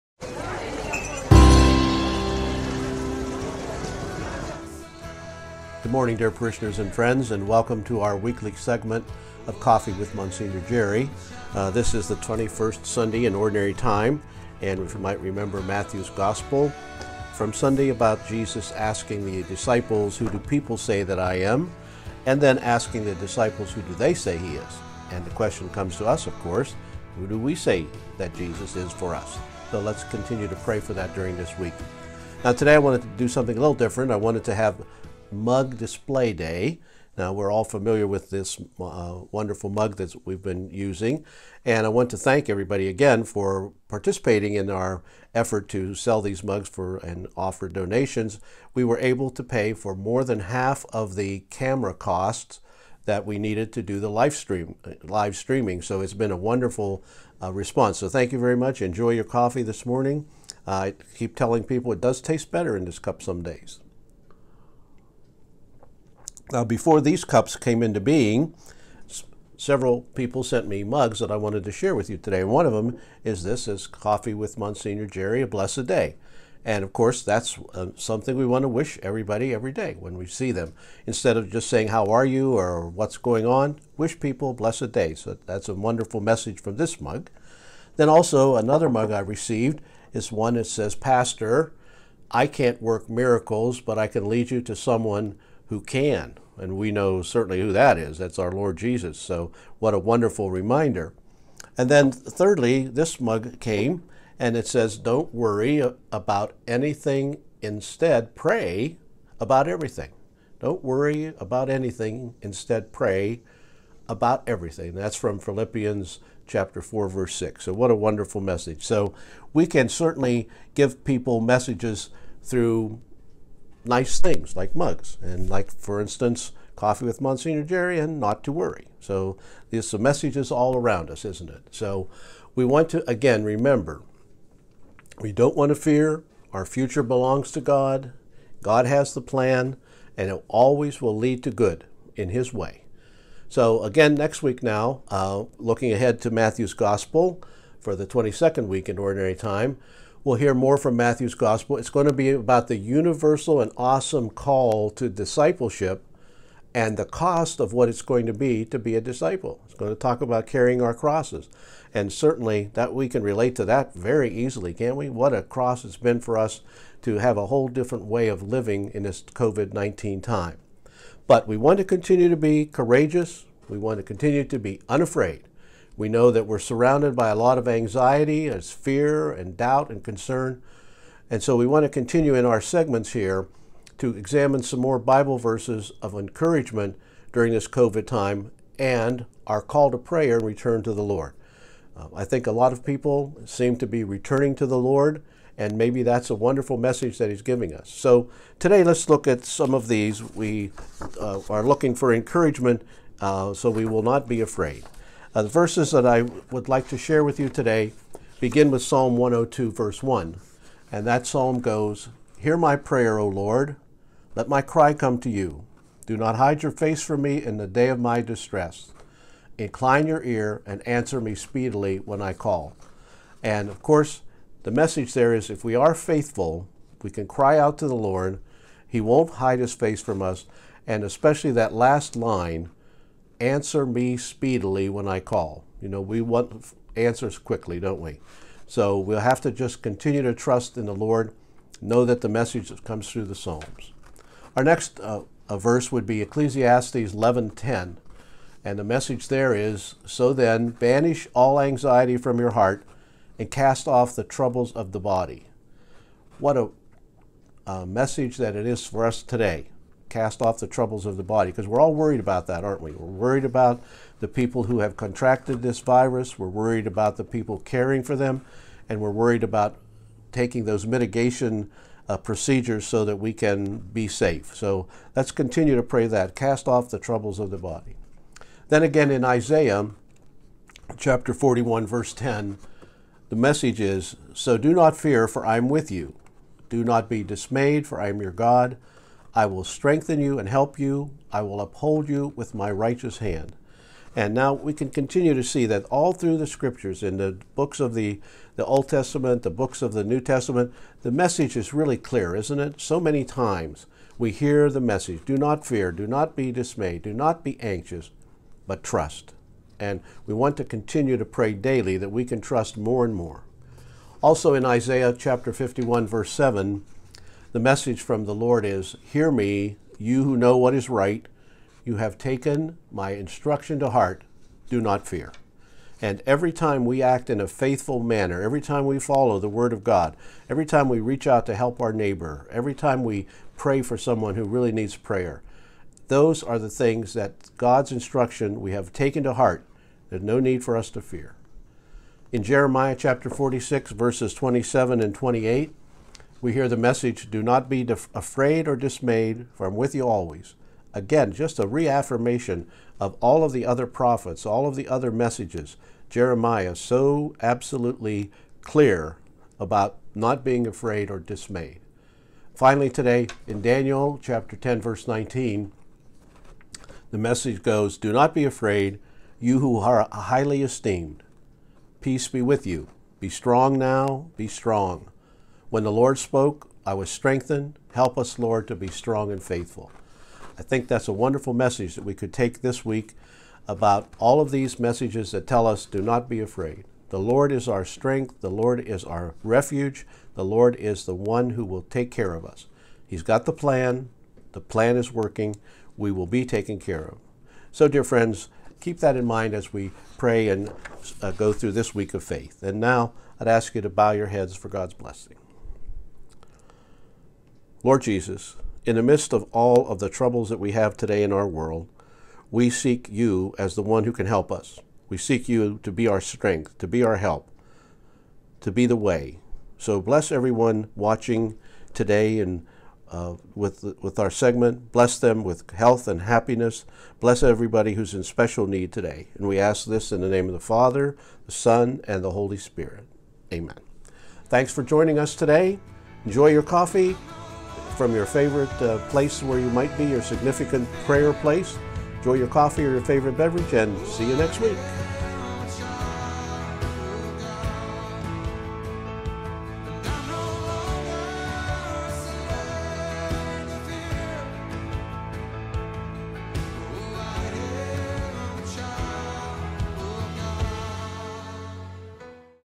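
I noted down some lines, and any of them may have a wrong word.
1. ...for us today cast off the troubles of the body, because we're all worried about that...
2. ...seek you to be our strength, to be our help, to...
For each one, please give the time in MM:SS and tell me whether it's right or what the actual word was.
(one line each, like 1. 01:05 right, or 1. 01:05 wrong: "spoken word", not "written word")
1. 04:18 right
2. 06:55 right.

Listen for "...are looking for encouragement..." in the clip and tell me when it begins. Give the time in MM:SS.
03:21.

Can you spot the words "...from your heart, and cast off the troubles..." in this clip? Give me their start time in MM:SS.
04:12.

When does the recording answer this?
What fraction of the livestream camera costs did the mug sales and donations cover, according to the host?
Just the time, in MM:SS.
00:49.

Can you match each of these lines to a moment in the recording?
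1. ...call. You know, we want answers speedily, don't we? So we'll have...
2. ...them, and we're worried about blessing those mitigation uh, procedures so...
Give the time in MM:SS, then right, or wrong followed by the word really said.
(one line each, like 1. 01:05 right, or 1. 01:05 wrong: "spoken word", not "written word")
1. 03:55 wrong: "quickly", not "speedily"
2. 04:28 wrong: "taking", not "blessing".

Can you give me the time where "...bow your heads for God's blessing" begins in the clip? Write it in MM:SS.
06:43.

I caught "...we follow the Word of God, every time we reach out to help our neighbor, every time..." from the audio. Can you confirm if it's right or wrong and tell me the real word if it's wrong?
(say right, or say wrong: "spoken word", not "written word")
right.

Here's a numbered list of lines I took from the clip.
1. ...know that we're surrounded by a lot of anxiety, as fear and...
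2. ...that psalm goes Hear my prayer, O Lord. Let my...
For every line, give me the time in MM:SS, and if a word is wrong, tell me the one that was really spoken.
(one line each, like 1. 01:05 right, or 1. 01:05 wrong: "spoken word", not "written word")
1. 02:56 right
2. 03:31 right.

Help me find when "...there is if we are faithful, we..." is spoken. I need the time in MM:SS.
03:45.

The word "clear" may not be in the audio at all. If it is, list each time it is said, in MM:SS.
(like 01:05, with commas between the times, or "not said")
05:01, 05:58.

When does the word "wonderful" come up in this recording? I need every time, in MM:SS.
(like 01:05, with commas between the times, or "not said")
00:39, 00:56, 01:25, 01:39, 01:57, 03:16, 06:21.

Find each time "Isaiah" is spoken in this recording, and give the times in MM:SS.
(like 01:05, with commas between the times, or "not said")
04:39, 05:14.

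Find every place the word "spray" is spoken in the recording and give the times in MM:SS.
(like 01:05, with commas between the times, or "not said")
not said.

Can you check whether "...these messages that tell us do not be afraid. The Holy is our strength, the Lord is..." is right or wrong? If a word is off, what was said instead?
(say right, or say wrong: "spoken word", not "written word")
wrong: "Lord", not "Holy".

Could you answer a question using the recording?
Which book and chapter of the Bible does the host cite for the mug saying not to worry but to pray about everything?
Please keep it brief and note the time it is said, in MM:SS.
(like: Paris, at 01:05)
Philippians chapter 4, at 01:55.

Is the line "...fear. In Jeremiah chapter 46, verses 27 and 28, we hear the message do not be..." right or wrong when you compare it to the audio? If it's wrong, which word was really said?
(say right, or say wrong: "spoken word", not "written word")
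right.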